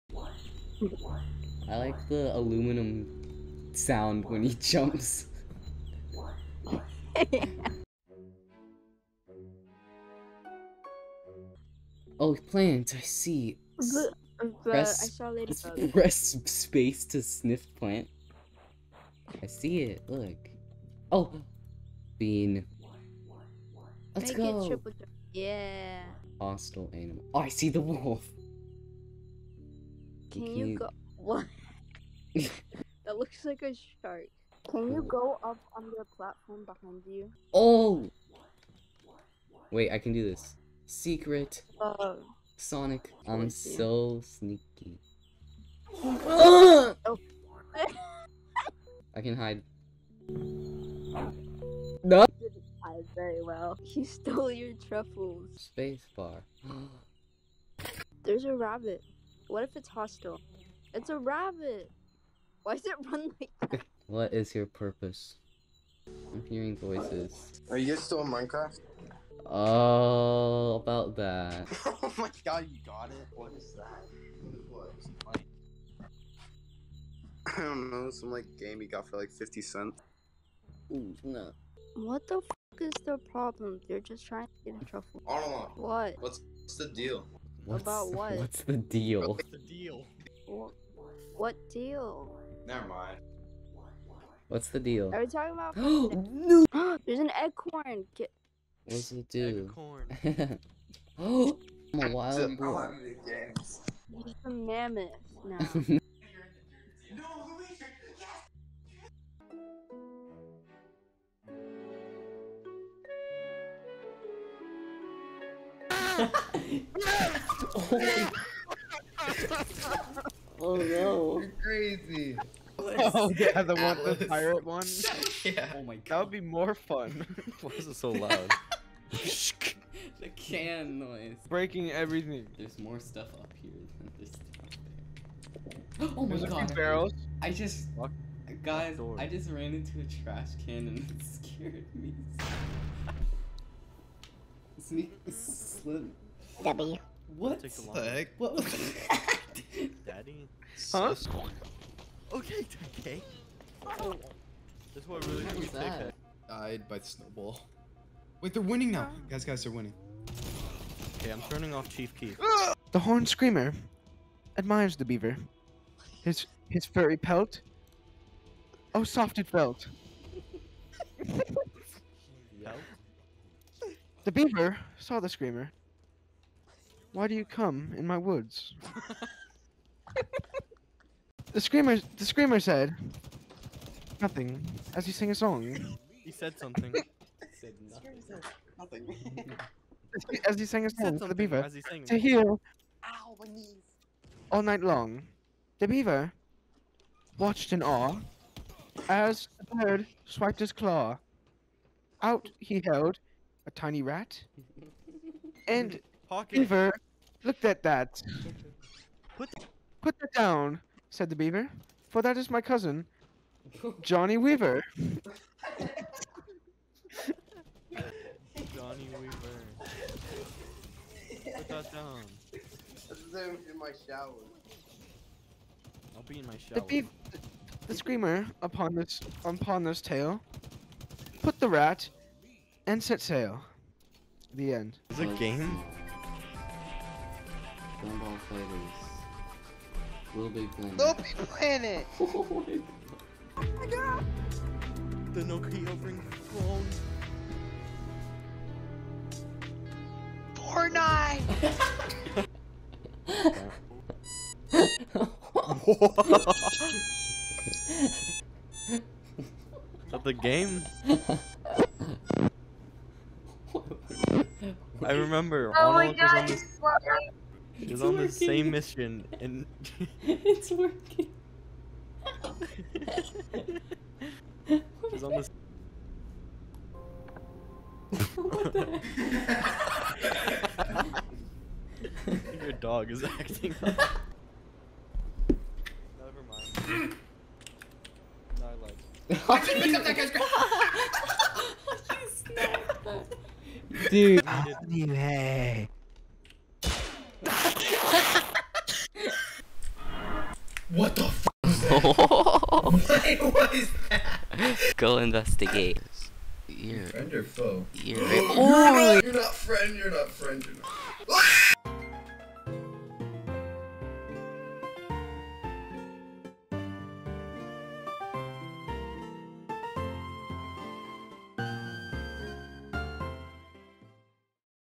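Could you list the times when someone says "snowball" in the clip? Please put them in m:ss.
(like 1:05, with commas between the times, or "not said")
2:37.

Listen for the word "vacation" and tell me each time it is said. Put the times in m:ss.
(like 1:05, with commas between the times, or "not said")
not said.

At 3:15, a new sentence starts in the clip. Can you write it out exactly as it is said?
The beaver watched in awe as the bird swiped his claw.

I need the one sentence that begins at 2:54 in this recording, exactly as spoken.
the beaver saw the screamer why do you come in my woods?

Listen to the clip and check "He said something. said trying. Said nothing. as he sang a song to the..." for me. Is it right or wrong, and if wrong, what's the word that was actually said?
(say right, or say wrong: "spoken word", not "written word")
wrong: "nothing", not "trying".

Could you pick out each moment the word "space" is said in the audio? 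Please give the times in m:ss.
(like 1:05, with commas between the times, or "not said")
0:16, 0:55.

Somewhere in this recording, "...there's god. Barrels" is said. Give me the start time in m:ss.
2:16.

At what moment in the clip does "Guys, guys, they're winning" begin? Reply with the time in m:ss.
2:39.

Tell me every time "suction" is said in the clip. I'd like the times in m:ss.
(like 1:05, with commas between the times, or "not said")
not said.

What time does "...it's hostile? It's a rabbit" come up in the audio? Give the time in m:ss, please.
0:59.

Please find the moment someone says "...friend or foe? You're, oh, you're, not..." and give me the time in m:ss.
5:07.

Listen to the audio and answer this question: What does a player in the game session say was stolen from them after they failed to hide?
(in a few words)
truffles.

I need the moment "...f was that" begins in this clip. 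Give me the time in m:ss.
5:01.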